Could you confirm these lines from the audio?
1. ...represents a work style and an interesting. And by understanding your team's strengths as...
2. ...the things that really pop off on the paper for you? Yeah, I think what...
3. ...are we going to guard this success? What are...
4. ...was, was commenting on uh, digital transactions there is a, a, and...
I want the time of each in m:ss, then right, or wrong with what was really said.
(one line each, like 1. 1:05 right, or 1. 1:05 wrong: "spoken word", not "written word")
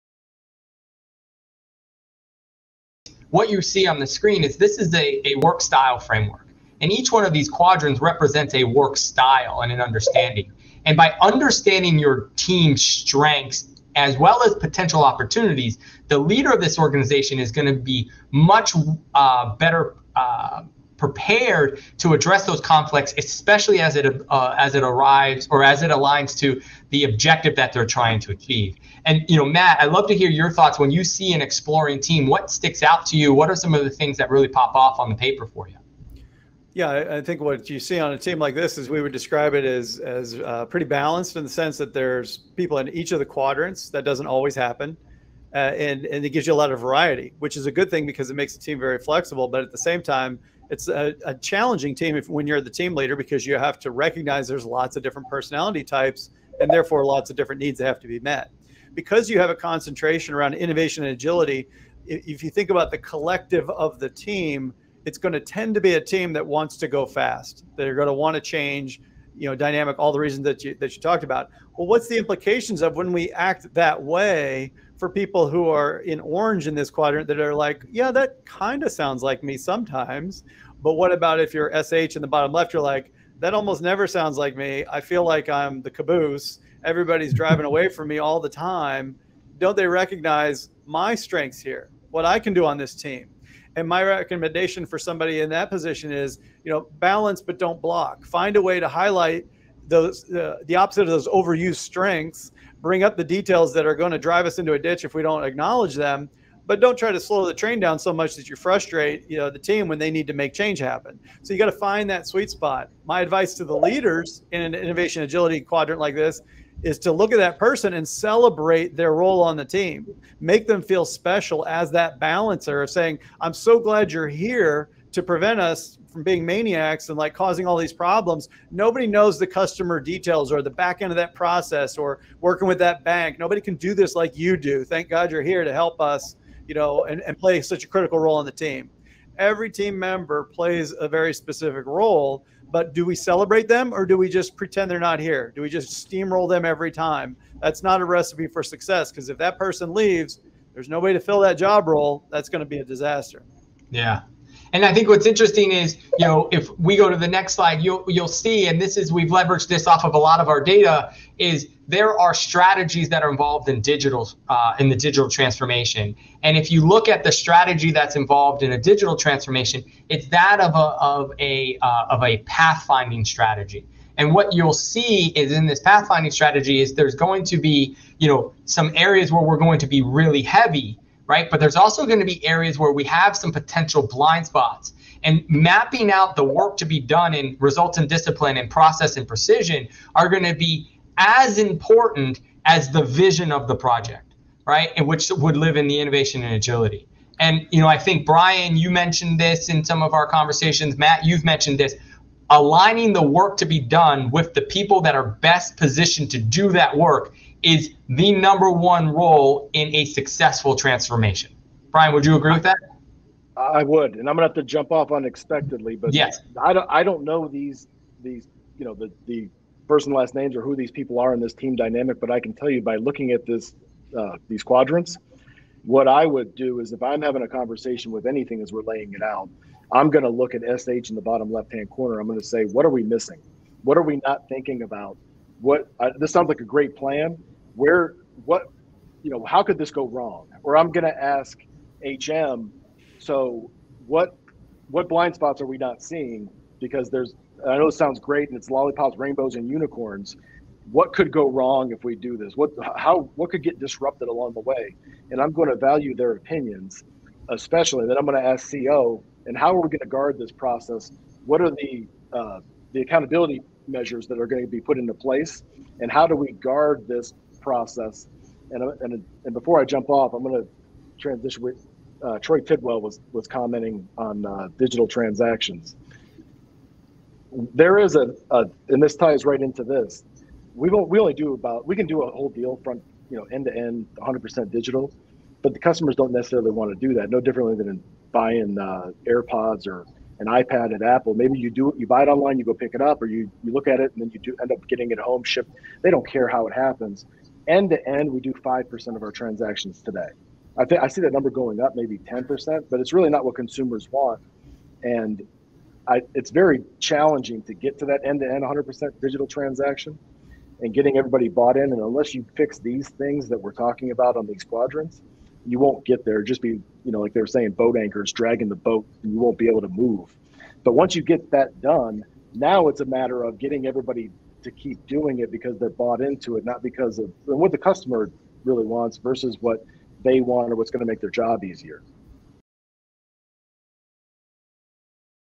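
1. 0:08 wrong: "understanding", not "interesting"
2. 0:33 right
3. 4:19 wrong: "process", not "success"
4. 4:33 right.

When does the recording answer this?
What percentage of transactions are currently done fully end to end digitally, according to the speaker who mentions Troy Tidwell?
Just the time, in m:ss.
4:58.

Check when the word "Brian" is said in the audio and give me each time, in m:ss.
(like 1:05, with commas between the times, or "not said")
3:18, 3:31.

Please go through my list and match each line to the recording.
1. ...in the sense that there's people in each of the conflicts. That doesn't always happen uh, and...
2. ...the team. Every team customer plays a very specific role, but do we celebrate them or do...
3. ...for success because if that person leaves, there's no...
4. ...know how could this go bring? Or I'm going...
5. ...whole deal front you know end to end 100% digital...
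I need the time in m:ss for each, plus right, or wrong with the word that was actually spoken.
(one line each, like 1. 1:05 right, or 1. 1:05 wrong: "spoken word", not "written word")
1. 0:41 wrong: "quadrants", not "conflicts"
2. 2:18 wrong: "member", not "customer"
3. 2:28 right
4. 3:59 wrong: "wrong", not "bring"
5. 4:42 right.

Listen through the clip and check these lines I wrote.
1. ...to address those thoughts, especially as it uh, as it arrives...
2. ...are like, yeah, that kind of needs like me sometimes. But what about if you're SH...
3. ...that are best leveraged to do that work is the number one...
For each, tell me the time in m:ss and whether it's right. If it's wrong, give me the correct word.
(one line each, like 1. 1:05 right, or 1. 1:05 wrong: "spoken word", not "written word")
1. 0:21 wrong: "conflicts", not "thoughts"
2. 1:17 wrong: "sounds", not "needs"
3. 3:25 wrong: "positioned", not "leveraged".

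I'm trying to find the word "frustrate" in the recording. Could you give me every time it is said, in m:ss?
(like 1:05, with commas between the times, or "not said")
1:48.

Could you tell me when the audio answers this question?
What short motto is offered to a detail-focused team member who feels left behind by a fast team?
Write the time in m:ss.
1:36.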